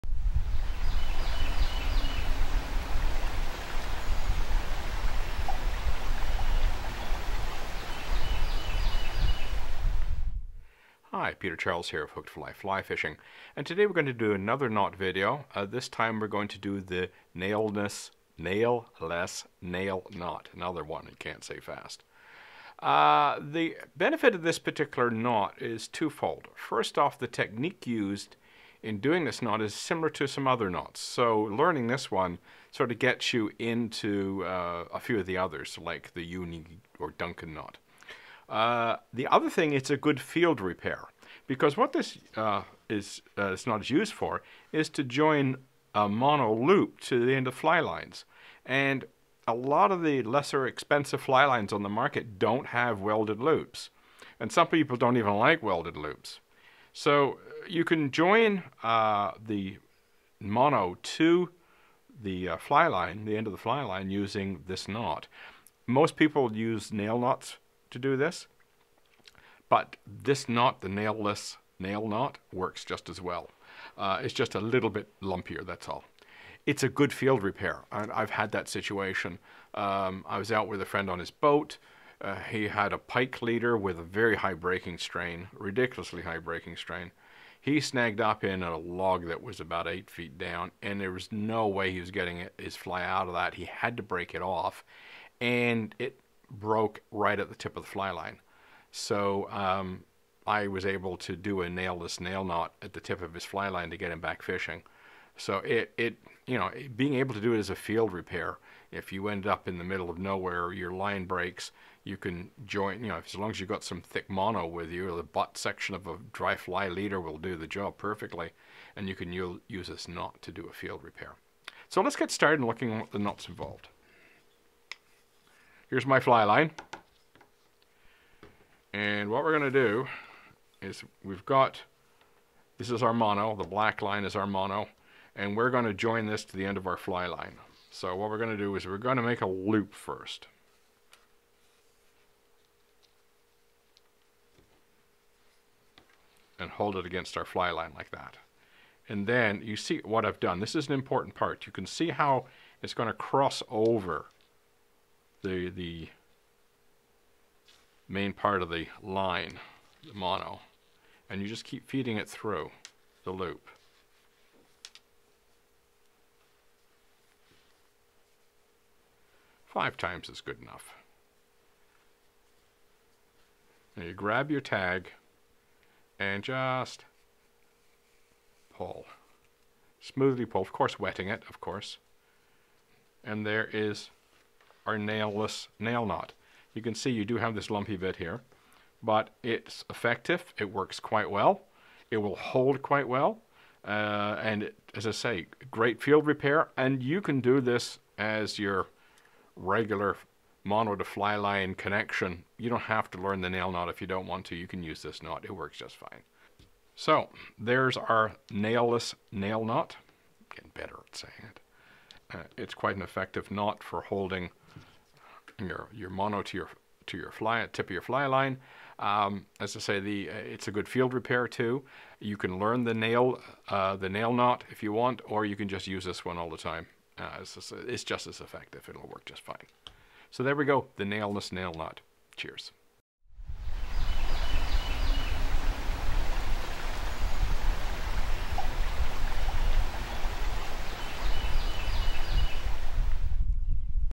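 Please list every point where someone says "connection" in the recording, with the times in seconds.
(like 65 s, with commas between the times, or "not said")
201 s.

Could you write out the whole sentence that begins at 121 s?
So let's get started looking at the knots involved.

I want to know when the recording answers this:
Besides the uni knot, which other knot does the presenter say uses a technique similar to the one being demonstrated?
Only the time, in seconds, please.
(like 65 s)
37 s.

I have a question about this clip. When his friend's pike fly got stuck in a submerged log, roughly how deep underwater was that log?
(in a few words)
8 feet.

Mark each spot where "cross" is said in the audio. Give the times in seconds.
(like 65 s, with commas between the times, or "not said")
153 s.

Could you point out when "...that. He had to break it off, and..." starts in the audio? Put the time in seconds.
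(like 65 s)
93 s.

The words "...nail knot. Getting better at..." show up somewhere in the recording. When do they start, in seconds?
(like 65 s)
209 s.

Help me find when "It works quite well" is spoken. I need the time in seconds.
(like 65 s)
190 s.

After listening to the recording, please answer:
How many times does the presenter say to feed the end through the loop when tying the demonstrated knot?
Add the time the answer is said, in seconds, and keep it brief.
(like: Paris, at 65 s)
5, at 169 s.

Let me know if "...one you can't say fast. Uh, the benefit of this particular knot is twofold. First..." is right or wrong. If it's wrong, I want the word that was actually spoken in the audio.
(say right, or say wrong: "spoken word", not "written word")
right.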